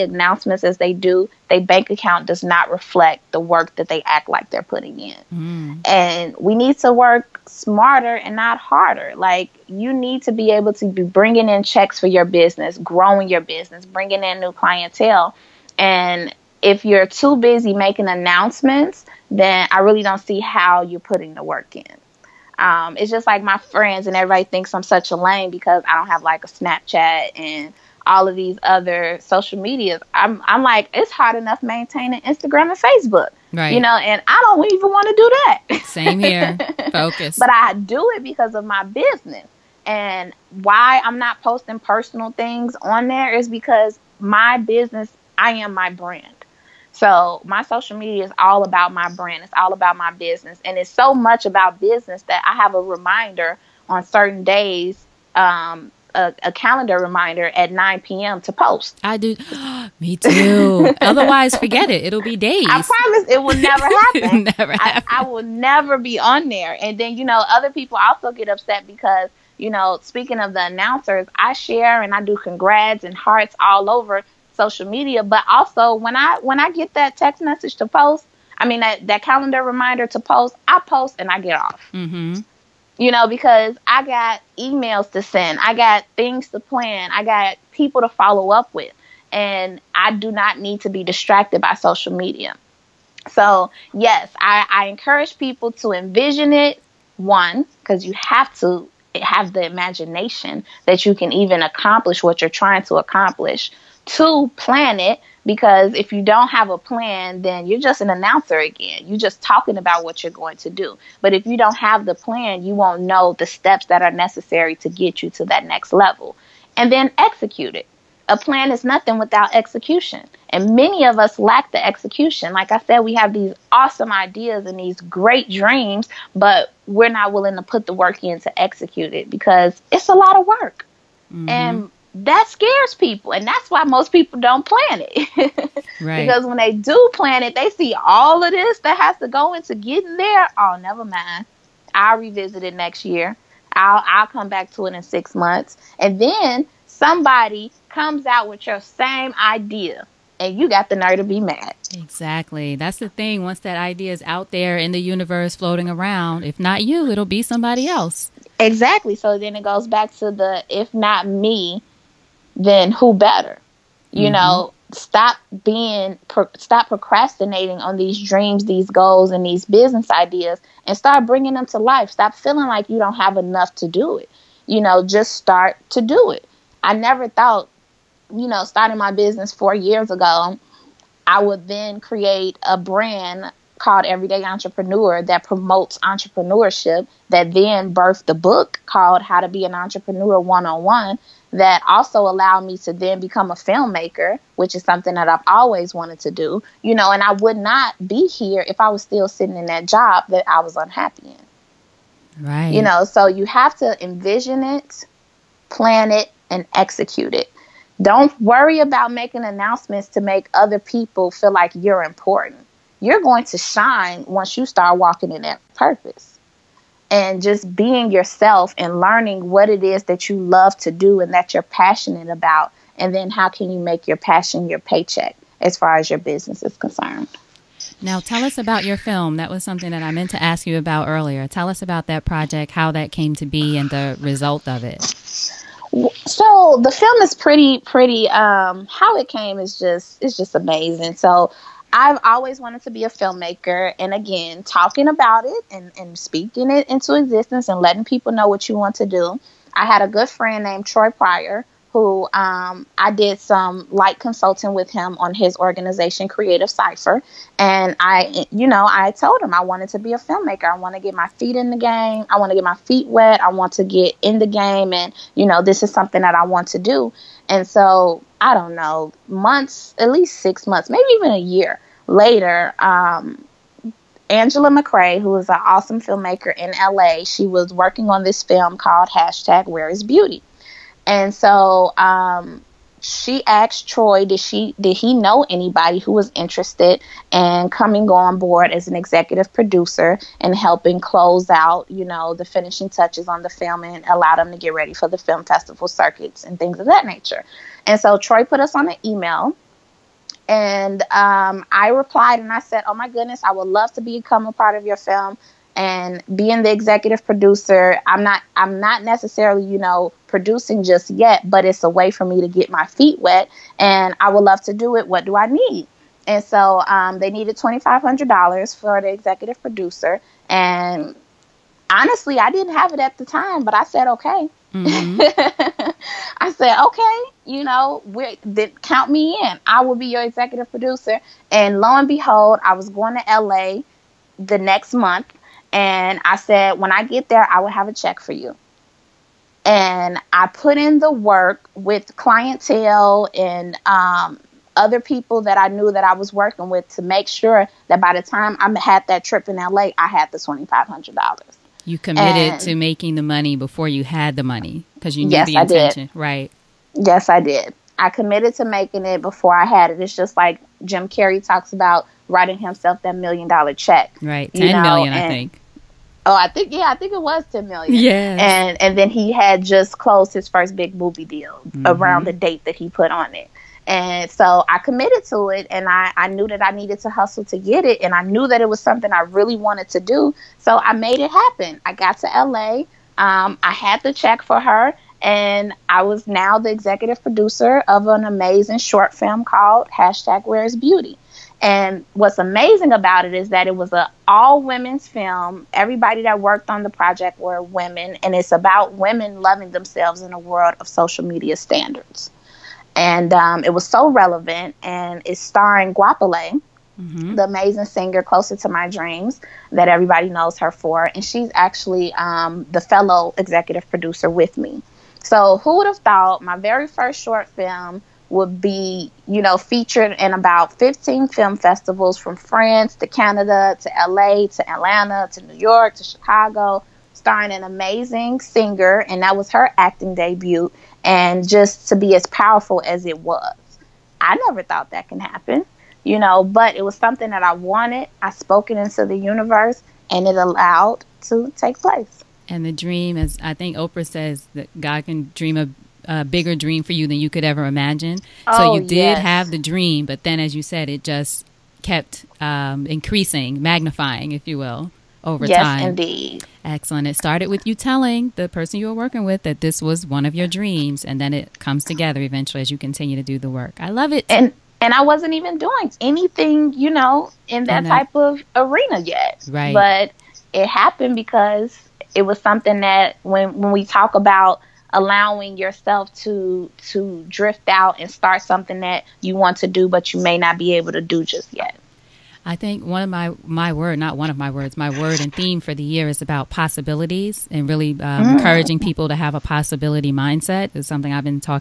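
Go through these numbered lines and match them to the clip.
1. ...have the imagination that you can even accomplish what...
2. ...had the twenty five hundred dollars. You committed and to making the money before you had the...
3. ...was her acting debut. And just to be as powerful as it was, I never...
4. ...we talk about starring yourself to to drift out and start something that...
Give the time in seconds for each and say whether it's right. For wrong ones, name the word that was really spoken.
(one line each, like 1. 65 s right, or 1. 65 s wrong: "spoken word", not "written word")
1. 99 s right
2. 350 s right
3. 429 s right
4. 473 s wrong: "allowing", not "starring".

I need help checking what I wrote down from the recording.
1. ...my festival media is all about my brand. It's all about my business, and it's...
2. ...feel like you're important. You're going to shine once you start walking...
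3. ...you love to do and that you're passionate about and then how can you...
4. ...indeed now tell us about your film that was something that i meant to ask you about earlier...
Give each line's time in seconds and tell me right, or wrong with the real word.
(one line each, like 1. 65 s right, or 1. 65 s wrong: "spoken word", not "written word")
1. 47 s wrong: "social", not "festival"
2. 211 s right
3. 220 s right
4. 226 s wrong: "concerned", not "indeed".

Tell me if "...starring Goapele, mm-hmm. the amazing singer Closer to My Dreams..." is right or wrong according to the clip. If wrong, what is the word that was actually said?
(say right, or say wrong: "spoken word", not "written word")
right.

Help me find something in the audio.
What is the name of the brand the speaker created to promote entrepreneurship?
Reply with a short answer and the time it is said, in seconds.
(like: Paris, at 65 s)
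Everyday Entrepreneur, at 184 s.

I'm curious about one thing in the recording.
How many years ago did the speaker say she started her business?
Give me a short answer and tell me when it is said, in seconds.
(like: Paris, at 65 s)
4, at 179 s.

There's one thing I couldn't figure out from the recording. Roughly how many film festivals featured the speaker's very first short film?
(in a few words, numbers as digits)
15.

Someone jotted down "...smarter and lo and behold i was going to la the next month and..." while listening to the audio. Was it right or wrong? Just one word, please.
wrong.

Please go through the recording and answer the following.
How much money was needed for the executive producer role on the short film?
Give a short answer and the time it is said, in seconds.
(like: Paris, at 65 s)
$2500, at 317 s.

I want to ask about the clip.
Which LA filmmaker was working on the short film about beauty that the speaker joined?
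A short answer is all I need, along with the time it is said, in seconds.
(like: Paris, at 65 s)
Angela McCrae, at 274 s.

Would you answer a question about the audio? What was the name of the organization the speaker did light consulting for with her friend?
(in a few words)
Creative Cipher.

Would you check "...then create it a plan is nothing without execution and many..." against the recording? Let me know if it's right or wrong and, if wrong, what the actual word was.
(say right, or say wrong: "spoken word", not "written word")
wrong: "execute", not "create".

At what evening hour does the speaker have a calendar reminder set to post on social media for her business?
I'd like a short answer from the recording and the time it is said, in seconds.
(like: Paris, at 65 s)
9 p.m., at 57 s.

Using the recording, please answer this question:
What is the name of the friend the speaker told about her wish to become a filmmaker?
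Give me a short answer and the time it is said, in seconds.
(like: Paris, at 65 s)
Troy Pryor, at 250 s.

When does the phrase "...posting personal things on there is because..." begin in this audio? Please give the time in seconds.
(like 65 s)
41 s.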